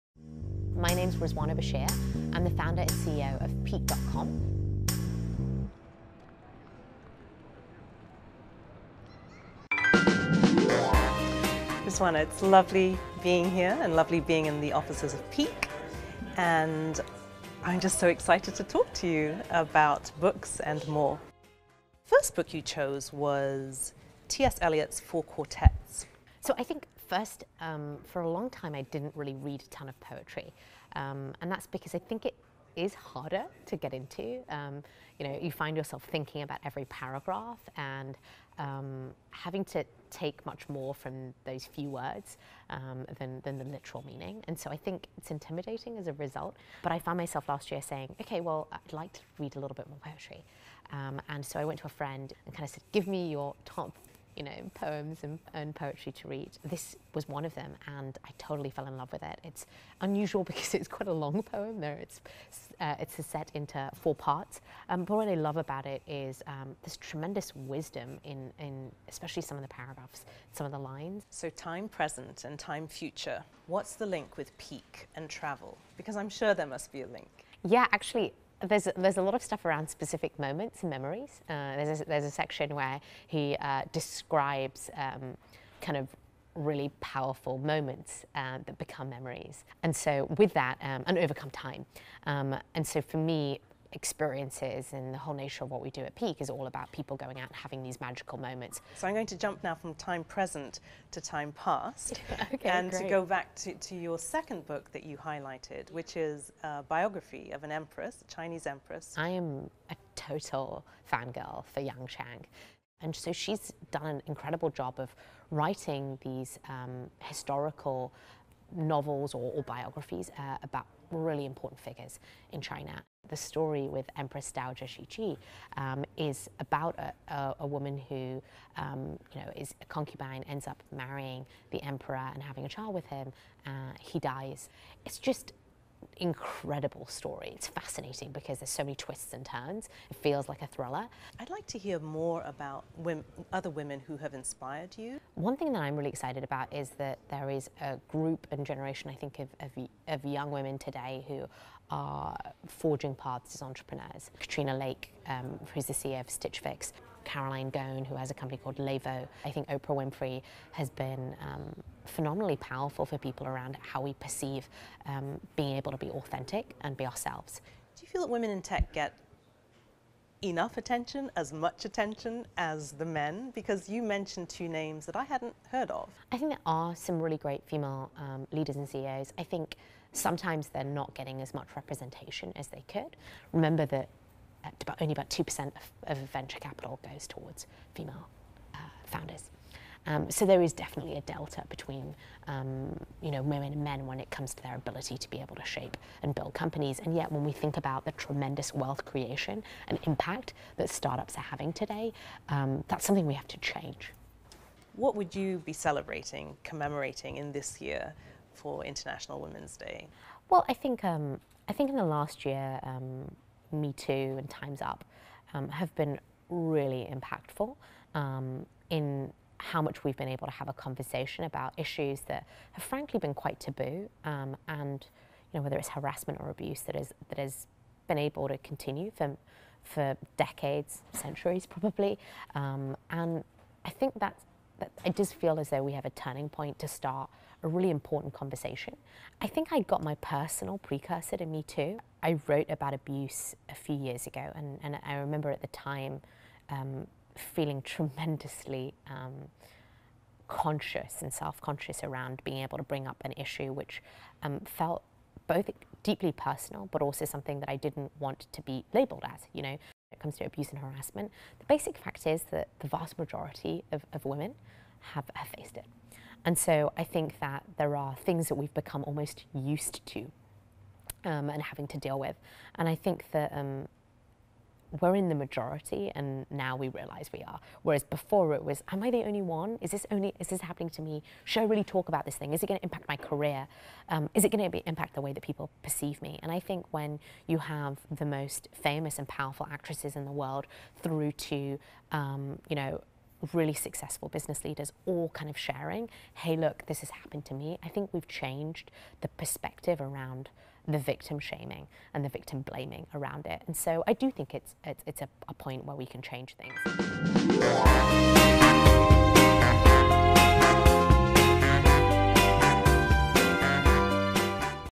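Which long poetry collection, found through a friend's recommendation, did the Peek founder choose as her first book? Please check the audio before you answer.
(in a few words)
Four Quartets.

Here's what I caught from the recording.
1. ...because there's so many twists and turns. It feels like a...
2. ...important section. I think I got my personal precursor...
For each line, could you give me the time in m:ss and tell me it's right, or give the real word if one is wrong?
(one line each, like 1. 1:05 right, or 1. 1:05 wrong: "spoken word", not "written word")
1. 2:18 right
2. 3:57 wrong: "conversation", not "section".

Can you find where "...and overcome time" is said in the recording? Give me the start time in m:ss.
1:31.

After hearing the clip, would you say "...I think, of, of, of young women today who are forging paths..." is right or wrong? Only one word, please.
right.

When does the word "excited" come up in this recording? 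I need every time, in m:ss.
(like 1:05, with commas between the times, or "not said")
0:18, 2:26.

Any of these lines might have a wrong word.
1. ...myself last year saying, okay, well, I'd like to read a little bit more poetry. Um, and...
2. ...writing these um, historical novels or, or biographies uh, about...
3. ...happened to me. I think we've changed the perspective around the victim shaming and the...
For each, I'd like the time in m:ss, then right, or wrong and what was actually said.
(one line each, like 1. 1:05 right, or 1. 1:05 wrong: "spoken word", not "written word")
1. 0:47 right
2. 1:55 right
3. 4:57 right.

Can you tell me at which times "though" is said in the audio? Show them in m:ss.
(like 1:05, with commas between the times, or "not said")
3:55.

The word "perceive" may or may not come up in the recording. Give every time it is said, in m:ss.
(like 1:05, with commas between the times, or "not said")
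2:44, 4:45.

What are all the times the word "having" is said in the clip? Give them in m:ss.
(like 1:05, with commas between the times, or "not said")
0:39, 1:37, 2:12, 3:21, 4:31.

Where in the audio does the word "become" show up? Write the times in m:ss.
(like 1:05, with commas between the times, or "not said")
1:28, 4:28.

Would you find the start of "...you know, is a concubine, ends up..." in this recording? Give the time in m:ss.
2:09.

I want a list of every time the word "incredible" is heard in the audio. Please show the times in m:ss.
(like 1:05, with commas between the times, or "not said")
1:54, 2:16.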